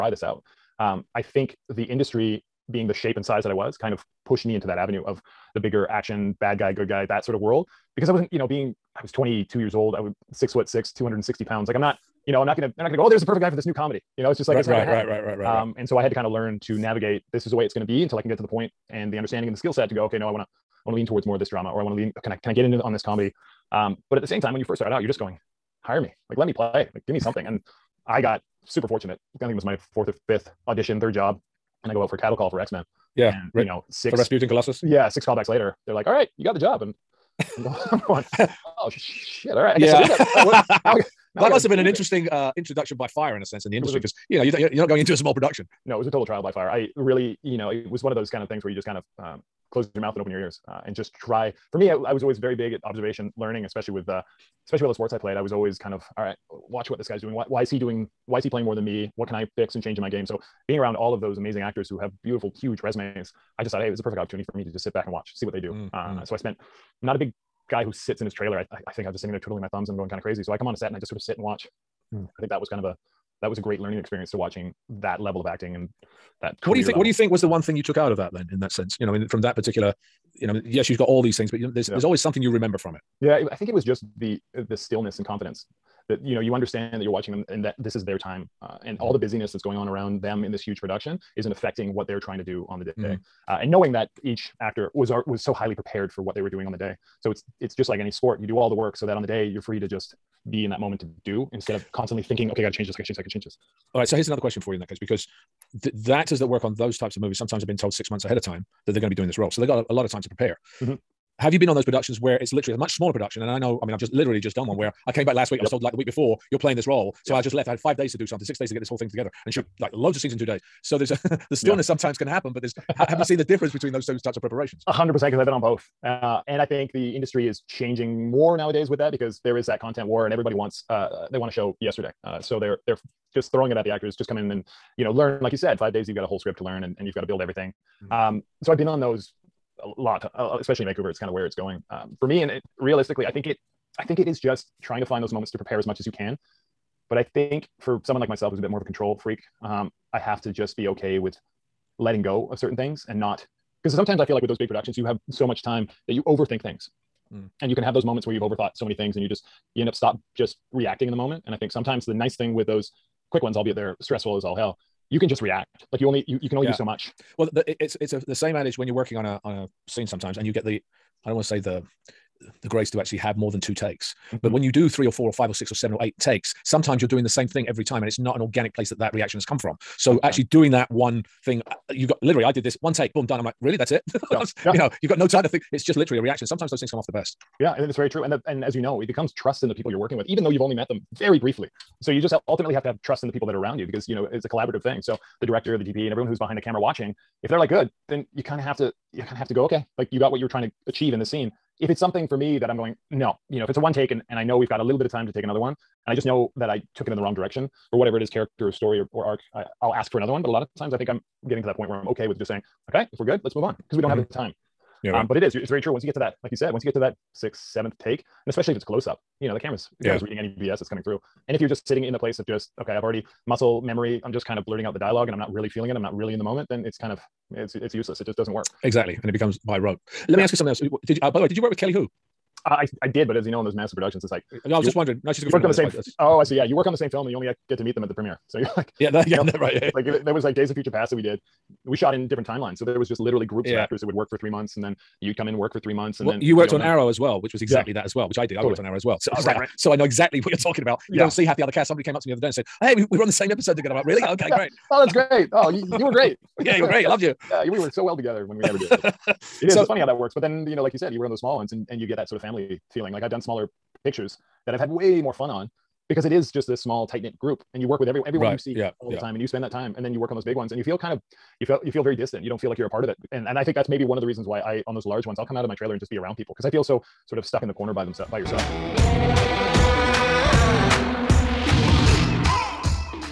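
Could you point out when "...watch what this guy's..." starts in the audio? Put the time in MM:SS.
00:56.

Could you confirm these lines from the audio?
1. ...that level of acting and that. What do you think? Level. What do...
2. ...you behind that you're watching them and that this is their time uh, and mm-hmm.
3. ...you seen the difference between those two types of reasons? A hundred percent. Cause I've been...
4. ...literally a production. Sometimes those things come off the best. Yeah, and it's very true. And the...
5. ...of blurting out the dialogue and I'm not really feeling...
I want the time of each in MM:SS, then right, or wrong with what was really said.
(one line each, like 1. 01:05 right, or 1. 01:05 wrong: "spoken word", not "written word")
1. 01:14 right
2. 01:26 wrong: "understand", not "behind"
3. 02:03 wrong: "preparations", not "reasons"
4. 03:05 wrong: "reaction", not "production"
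5. 03:44 right.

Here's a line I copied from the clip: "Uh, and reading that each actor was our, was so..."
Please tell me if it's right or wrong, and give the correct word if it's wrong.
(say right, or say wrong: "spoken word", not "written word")
wrong: "knowing", not "reading".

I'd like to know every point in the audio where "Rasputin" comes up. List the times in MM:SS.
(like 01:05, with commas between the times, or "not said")
00:34.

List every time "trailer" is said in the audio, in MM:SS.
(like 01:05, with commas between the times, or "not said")
01:08, 04:35.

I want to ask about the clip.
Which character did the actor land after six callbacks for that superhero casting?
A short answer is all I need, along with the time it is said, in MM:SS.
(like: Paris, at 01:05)
Colossus, at 00:34.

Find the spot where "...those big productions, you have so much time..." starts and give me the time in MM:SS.
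02:34.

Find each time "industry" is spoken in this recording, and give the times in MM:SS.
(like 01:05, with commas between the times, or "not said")
00:01, 00:43, 02:07.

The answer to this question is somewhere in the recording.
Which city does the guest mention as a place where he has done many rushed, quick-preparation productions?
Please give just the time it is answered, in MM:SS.
02:20.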